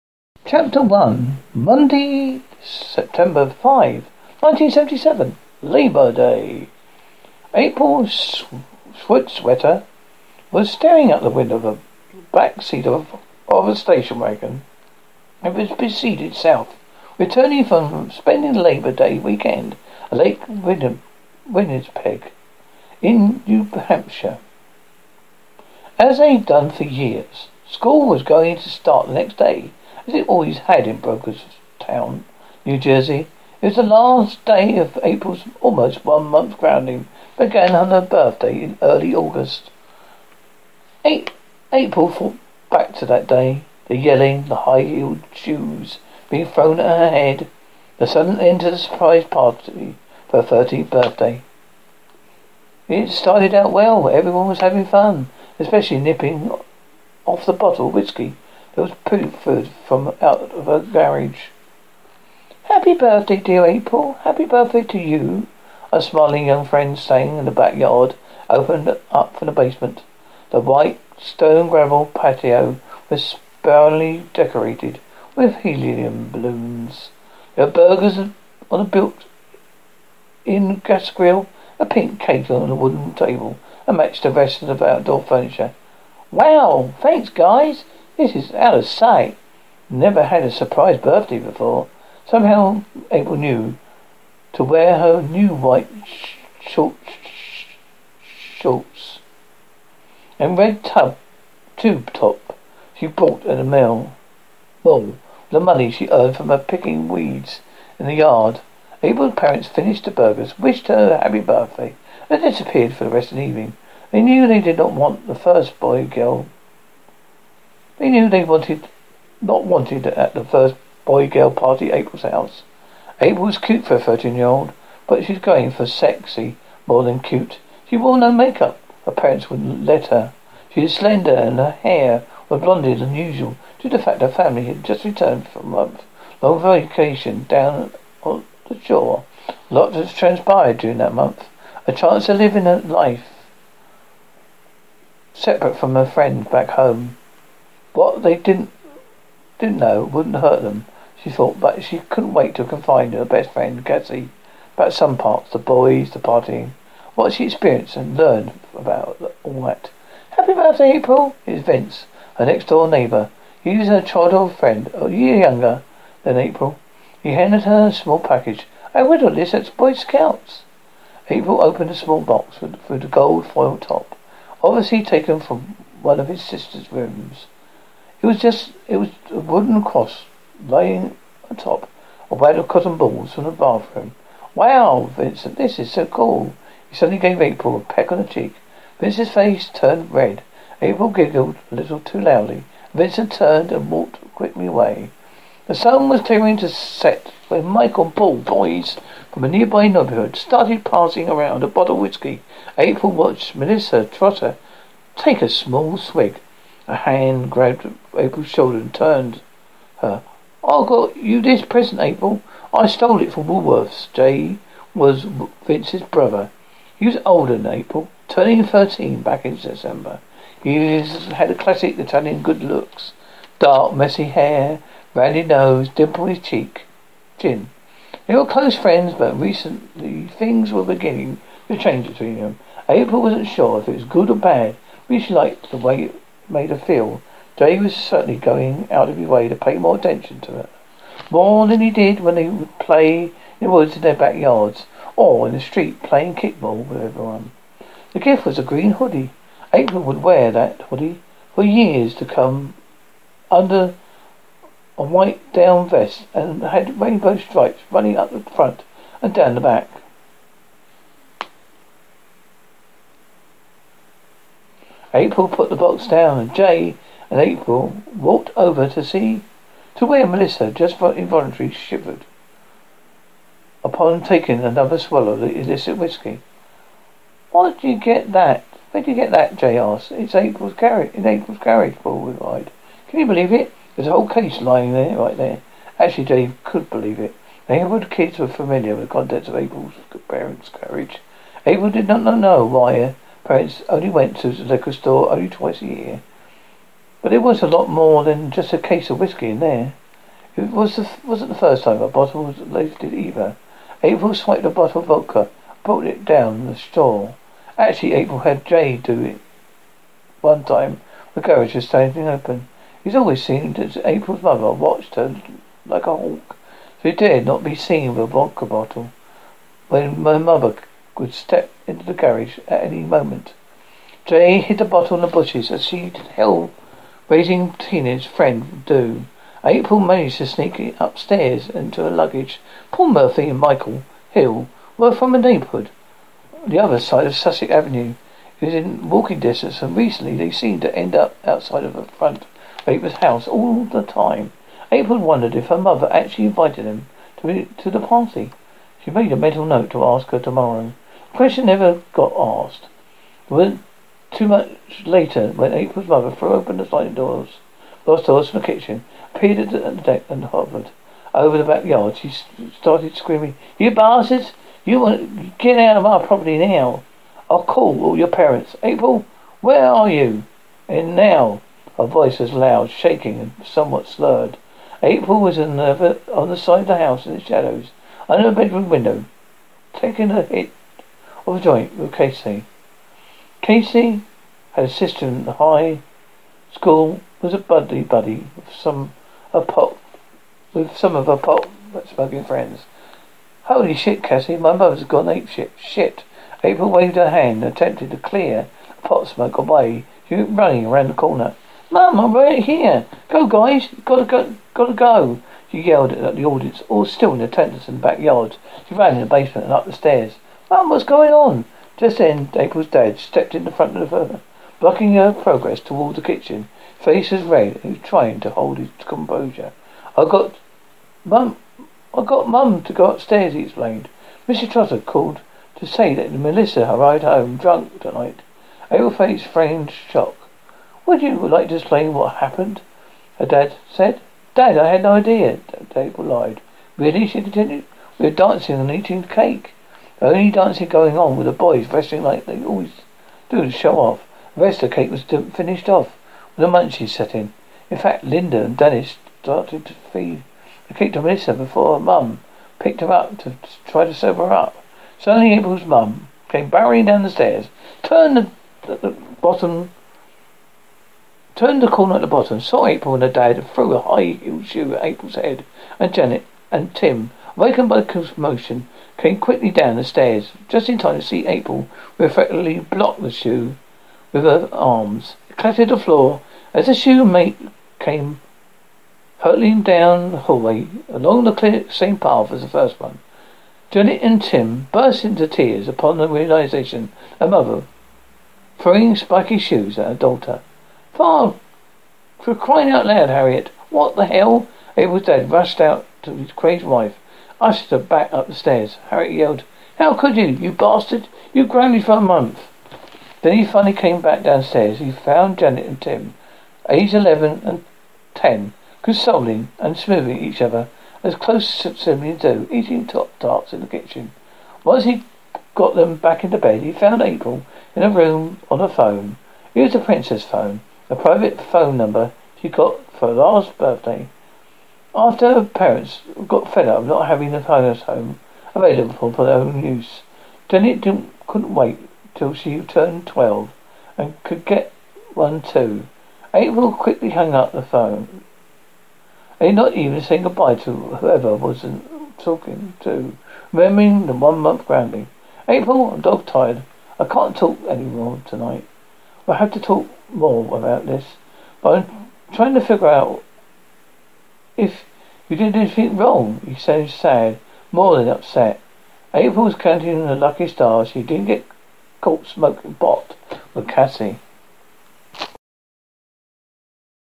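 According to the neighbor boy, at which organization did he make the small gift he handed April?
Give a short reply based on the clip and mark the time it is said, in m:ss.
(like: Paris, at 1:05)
Boy Scouts, at 2:49.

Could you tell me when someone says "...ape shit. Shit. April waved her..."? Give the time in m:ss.
6:35.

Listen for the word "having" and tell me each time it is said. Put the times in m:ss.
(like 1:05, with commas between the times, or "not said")
0:54, 8:47.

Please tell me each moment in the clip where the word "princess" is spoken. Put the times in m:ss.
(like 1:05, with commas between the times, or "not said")
8:39.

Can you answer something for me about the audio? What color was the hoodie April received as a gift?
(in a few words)
Green.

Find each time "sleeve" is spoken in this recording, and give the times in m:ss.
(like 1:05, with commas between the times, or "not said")
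not said.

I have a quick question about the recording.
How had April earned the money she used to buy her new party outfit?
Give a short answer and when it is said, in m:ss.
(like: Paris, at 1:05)
Picking weeds, at 1:46.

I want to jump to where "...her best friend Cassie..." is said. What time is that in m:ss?
2:33.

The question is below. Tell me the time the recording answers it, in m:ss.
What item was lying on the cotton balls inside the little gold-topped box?
2:59.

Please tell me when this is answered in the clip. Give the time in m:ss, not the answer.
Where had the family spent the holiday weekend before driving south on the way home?
0:20.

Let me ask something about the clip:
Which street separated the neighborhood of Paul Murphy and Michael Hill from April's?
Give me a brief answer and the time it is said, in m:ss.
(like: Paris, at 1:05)
Sussex Avenue, at 5:37.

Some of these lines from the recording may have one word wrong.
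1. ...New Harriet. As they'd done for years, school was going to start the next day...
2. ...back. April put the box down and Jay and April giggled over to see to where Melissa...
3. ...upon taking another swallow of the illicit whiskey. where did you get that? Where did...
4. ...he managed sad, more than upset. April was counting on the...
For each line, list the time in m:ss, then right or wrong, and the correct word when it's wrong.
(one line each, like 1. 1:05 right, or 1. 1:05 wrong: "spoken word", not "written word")
1. 0:23 wrong: "Hampshire", not "Harriet"
2. 4:19 wrong: "walked", not "giggled"
3. 4:33 right
4. 9:16 wrong: "sounded", not "managed".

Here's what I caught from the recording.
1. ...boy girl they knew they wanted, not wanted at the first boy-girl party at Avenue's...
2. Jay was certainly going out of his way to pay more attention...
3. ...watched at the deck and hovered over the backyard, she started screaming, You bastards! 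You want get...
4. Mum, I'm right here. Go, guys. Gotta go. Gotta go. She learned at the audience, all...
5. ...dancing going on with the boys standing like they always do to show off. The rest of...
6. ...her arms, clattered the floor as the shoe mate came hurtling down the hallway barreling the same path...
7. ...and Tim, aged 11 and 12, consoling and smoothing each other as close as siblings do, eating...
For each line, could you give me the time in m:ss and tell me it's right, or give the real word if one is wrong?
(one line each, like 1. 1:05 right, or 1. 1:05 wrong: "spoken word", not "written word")
1. 1:55 wrong: "April", not "Avenue"
2. 3:57 right
3. 5:59 wrong: "peered", not "watched"
4. 6:41 wrong: "yelled", not "learned"
5. 7:20 wrong: "wrestling", not "standing"
6. 7:54 wrong: "along", not "barreling"
7. 8:25 wrong: "10", not "12".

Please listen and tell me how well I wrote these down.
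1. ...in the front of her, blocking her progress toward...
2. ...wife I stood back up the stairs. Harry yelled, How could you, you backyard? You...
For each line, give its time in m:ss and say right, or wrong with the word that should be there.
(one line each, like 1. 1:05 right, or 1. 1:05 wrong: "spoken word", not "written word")
1. 6:53 right
2. 8:16 wrong: "bastard", not "backyard".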